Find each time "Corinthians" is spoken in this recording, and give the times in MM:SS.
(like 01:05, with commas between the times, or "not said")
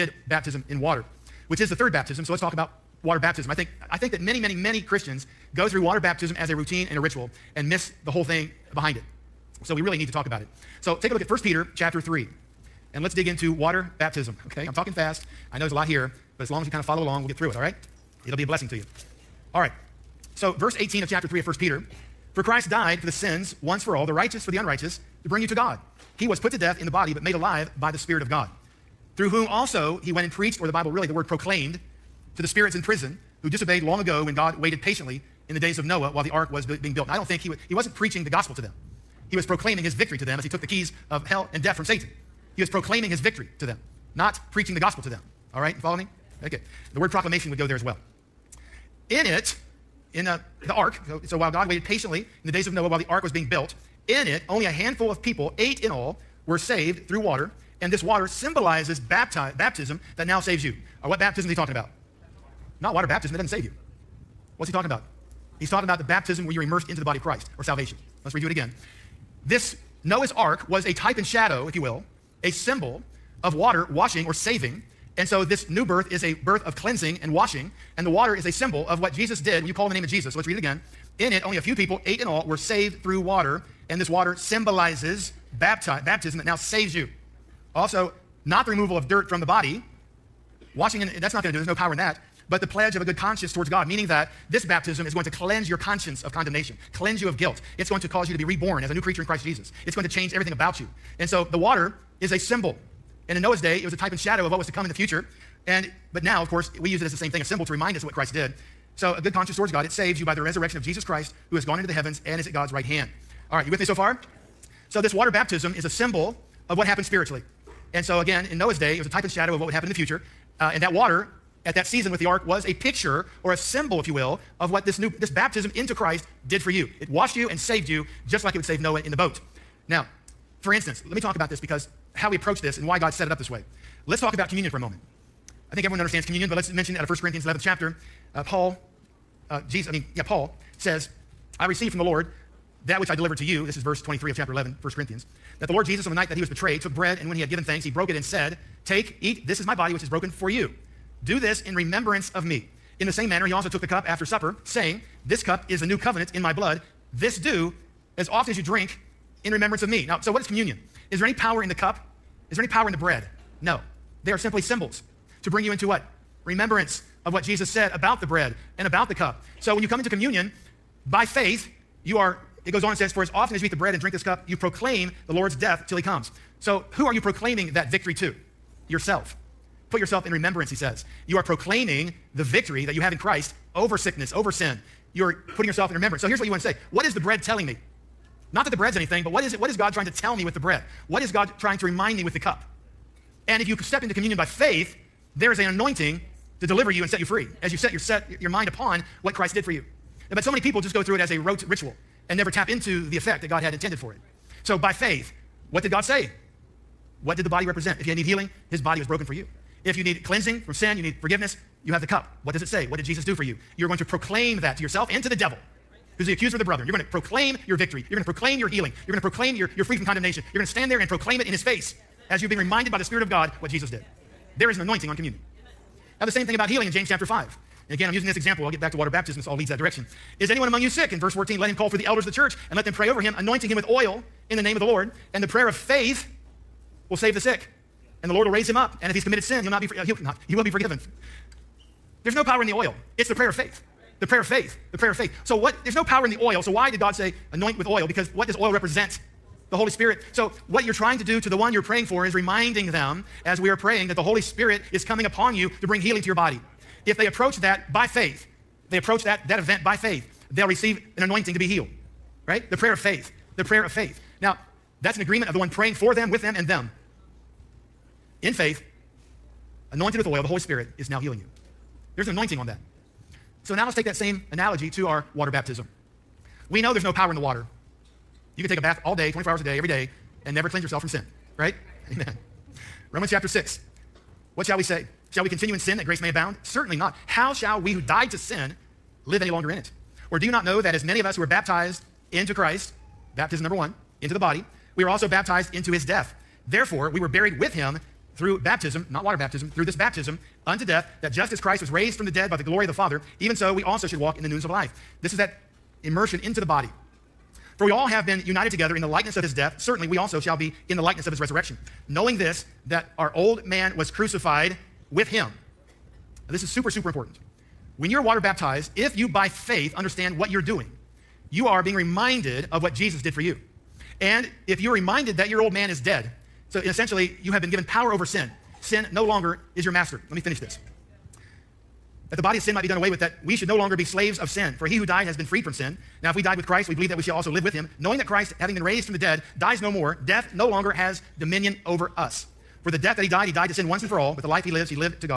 02:17, 02:24.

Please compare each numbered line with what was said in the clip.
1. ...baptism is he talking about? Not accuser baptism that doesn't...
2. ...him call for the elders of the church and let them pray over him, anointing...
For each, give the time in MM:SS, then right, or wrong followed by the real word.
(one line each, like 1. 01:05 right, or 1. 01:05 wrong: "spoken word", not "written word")
1. 01:01 wrong: "water", not "accuser"
2. 03:51 right.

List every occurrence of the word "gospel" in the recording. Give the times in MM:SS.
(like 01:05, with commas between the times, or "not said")
00:38, 00:44.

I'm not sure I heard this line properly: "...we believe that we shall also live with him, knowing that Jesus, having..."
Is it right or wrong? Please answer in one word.
wrong.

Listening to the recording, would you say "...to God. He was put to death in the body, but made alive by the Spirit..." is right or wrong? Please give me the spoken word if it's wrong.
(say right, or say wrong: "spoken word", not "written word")
right.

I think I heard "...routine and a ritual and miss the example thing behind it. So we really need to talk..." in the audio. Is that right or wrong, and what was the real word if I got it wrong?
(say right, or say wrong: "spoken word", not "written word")
wrong: "whole", not "example".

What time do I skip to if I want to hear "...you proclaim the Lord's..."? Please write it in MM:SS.
02:54.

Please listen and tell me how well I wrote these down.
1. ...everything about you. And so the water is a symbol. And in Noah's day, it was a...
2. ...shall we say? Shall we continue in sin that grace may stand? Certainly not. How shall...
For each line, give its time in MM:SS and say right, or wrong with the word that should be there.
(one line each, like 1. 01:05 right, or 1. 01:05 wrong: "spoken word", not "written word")
1. 01:40 right
2. 04:44 wrong: "abound", not "stand".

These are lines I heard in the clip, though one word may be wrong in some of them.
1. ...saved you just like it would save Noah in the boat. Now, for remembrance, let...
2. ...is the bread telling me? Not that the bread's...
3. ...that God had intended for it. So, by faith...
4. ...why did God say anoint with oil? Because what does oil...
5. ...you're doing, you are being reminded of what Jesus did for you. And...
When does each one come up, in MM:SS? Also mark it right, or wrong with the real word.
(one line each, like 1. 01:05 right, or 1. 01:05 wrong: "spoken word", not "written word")
1. 02:07 wrong: "instance", not "remembrance"
2. 03:07 right
3. 03:23 right
4. 04:06 right
5. 05:20 right.